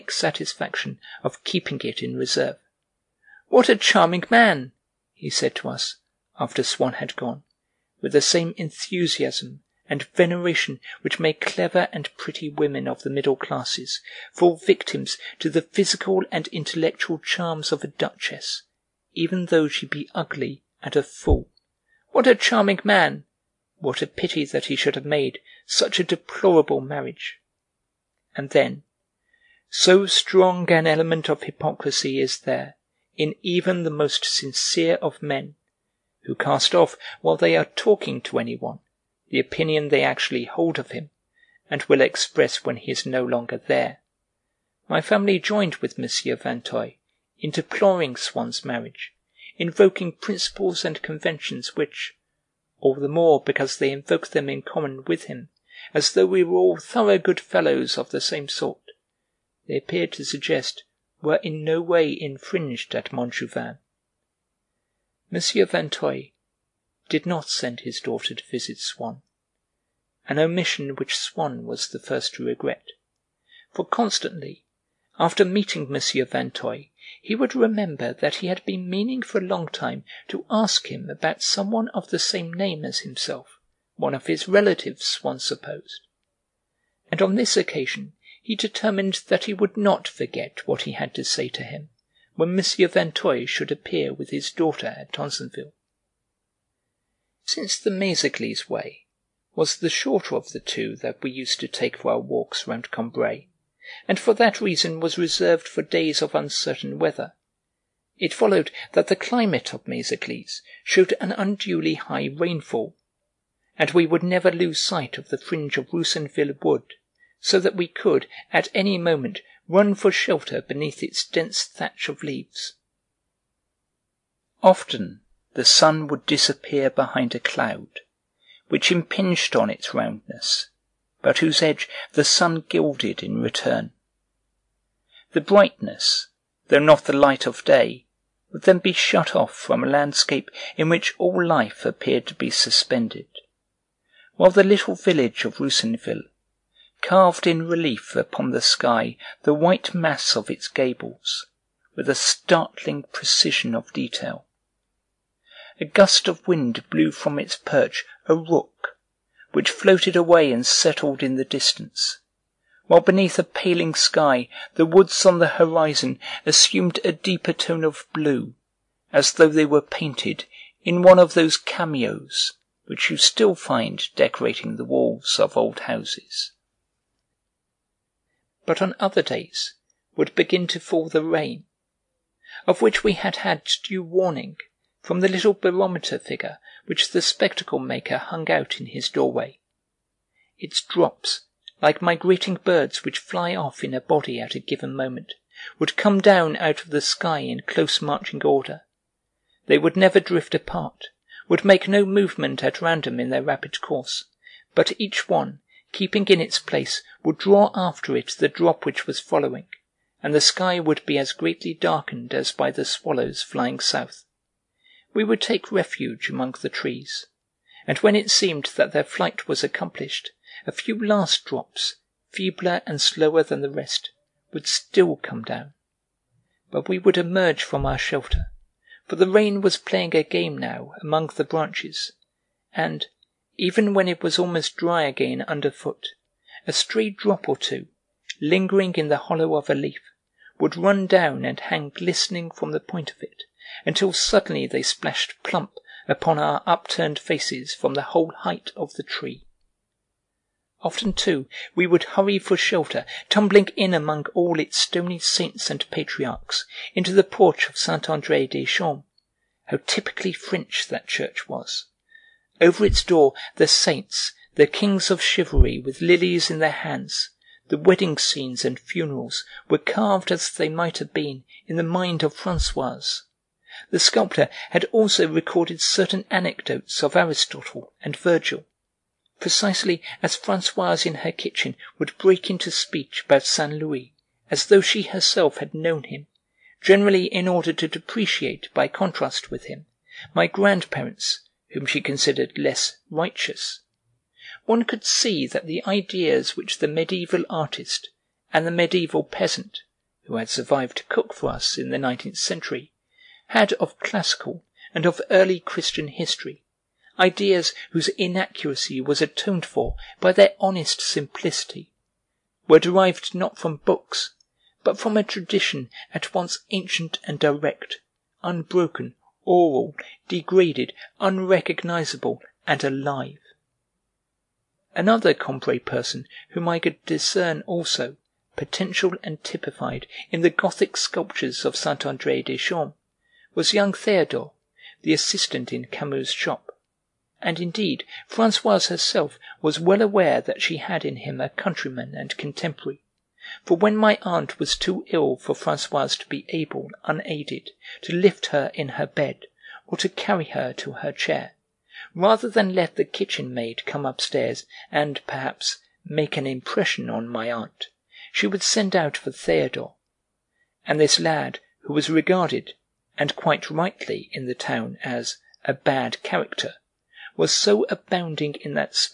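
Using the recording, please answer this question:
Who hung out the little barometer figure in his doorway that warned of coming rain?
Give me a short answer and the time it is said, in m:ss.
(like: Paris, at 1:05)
the spectacle maker, at 3:07.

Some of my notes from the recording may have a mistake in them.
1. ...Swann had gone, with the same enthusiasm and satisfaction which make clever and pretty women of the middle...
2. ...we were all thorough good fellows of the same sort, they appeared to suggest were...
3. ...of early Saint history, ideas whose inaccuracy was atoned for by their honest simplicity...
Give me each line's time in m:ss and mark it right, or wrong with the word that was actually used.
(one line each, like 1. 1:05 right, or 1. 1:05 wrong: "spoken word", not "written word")
1. 0:06 wrong: "veneration", not "satisfaction"
2. 0:56 right
3. 5:05 wrong: "Christian", not "Saint".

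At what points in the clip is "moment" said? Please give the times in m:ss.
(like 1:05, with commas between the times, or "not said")
1:58, 3:14.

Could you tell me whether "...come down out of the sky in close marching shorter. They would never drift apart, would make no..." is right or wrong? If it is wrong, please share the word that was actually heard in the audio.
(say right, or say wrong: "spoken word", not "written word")
wrong: "order", not "shorter".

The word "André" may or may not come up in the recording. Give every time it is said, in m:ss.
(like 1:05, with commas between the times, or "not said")
4:18, 5:32.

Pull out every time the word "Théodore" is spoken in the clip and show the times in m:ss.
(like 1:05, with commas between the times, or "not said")
5:33, 5:59.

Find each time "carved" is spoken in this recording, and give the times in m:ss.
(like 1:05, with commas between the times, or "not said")
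2:27, 4:29.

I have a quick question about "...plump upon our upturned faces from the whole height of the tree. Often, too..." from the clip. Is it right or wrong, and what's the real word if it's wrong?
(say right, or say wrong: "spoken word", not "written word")
right.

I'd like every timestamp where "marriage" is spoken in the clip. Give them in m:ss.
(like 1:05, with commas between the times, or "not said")
0:26, 0:48.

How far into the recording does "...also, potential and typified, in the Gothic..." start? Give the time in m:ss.
5:27.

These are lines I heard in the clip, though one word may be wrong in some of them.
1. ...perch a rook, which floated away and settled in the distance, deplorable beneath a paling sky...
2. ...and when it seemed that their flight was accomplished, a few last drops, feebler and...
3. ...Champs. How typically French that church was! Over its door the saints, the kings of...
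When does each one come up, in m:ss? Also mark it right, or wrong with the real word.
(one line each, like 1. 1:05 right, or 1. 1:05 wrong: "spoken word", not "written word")
1. 2:37 wrong: "while", not "deplorable"
2. 3:37 right
3. 4:18 right.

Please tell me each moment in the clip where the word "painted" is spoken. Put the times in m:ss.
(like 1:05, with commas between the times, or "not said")
2:49.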